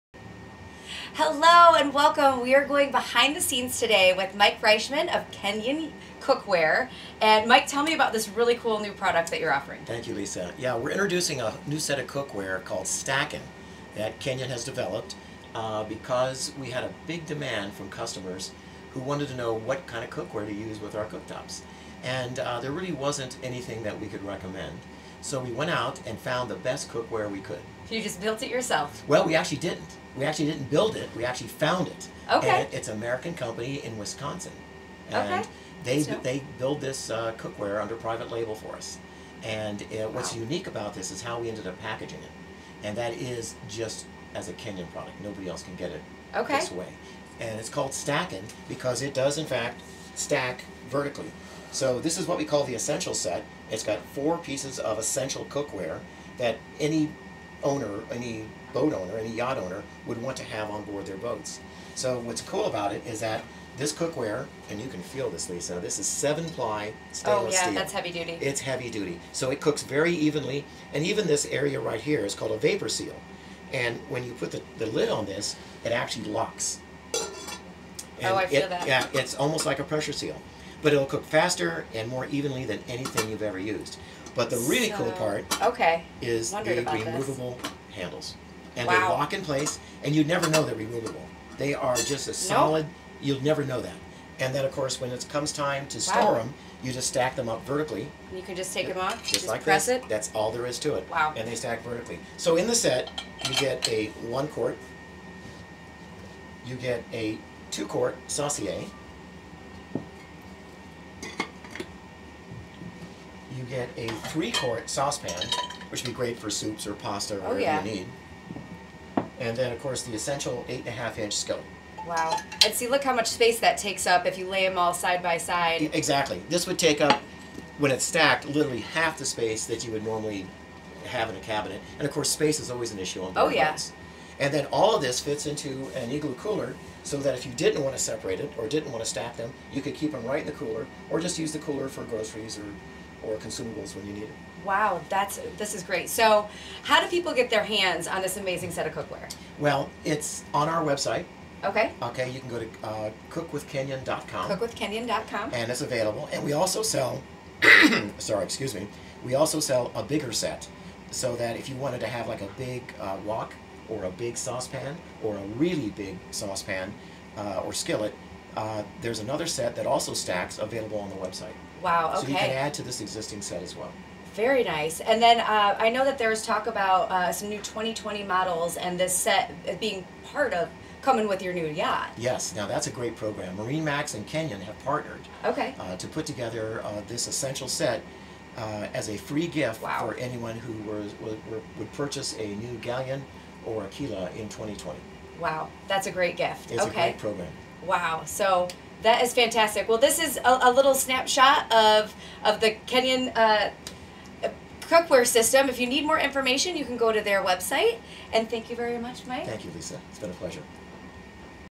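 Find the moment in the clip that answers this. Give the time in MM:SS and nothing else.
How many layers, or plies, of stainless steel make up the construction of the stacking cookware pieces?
01:06.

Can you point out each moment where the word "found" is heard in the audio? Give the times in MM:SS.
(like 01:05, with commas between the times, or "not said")
00:26, 00:31.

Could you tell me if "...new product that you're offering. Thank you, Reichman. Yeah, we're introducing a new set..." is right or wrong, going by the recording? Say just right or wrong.
wrong.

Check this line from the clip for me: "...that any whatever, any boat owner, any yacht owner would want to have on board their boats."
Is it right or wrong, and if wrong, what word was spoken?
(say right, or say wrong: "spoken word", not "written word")
wrong: "owner", not "whatever".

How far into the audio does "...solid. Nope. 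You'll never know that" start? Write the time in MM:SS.
01:32.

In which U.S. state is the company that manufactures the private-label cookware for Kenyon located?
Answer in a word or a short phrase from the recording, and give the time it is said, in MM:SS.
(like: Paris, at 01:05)
Wisconsin, at 00:33.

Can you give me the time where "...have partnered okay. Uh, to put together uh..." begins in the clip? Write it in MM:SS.
03:04.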